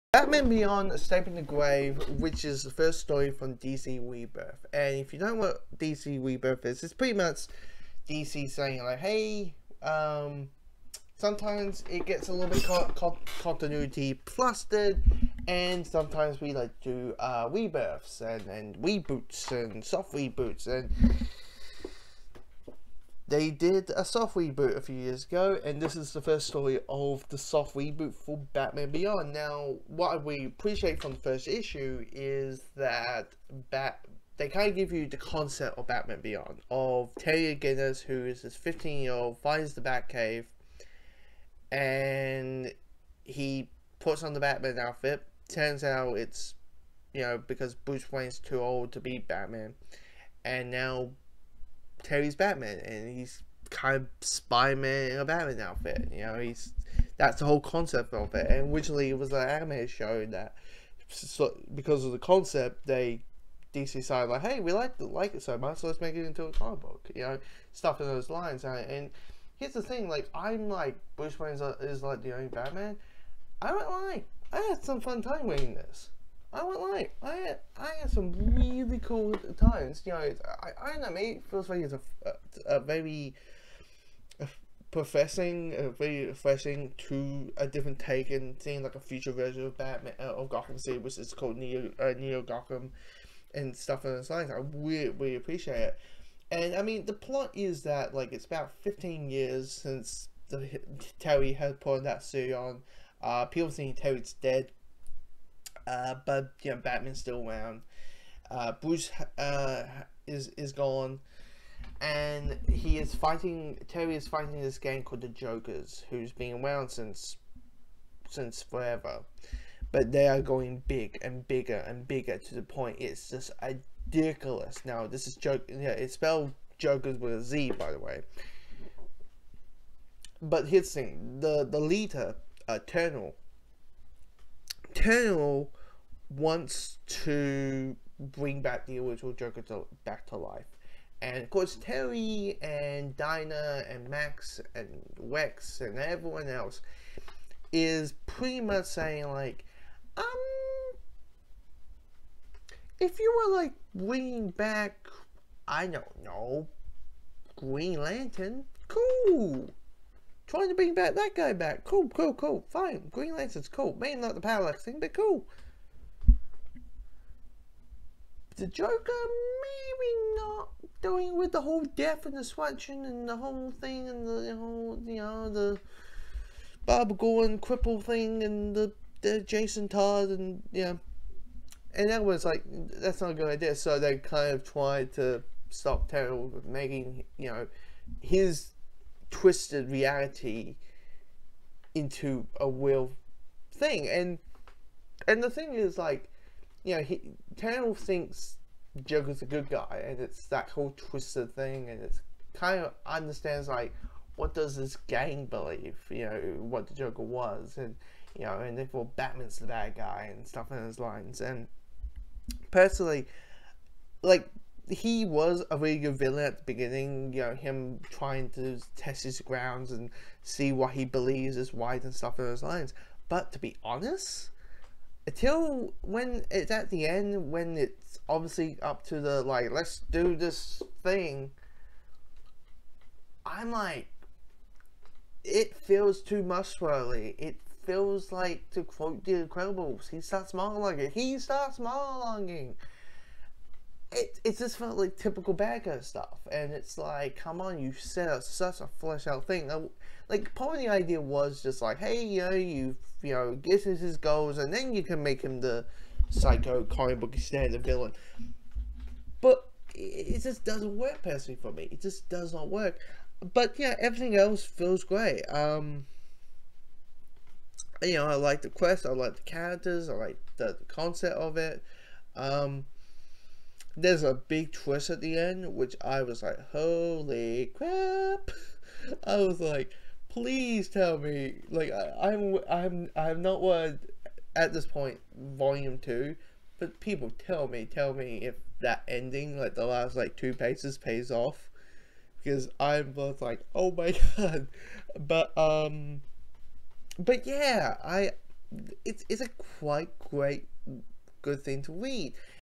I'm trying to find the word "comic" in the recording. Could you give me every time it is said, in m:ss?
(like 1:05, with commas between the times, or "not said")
1:06, 4:16.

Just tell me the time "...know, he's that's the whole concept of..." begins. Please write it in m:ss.
0:56.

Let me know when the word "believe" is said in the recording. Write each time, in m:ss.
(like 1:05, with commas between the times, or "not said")
3:25, 3:41.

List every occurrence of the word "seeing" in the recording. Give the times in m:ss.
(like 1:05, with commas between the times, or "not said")
1:28.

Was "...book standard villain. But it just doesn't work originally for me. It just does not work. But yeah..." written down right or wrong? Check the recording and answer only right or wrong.
wrong.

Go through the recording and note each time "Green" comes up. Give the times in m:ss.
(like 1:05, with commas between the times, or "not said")
2:37, 2:43.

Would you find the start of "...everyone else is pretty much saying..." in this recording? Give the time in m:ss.
2:25.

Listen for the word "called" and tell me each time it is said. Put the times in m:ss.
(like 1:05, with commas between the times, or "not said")
1:31, 1:55.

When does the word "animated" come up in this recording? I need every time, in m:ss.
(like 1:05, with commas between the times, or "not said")
0:59.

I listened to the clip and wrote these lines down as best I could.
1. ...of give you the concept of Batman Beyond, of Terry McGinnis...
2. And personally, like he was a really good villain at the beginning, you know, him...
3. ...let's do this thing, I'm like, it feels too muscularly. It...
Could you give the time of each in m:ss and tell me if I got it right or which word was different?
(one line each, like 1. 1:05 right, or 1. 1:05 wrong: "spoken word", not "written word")
1. 0:34 right
2. 3:31 right
3. 3:49 right.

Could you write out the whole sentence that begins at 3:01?
And that was like, that's not a good idea.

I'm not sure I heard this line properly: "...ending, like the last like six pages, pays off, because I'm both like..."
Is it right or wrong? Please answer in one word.
wrong.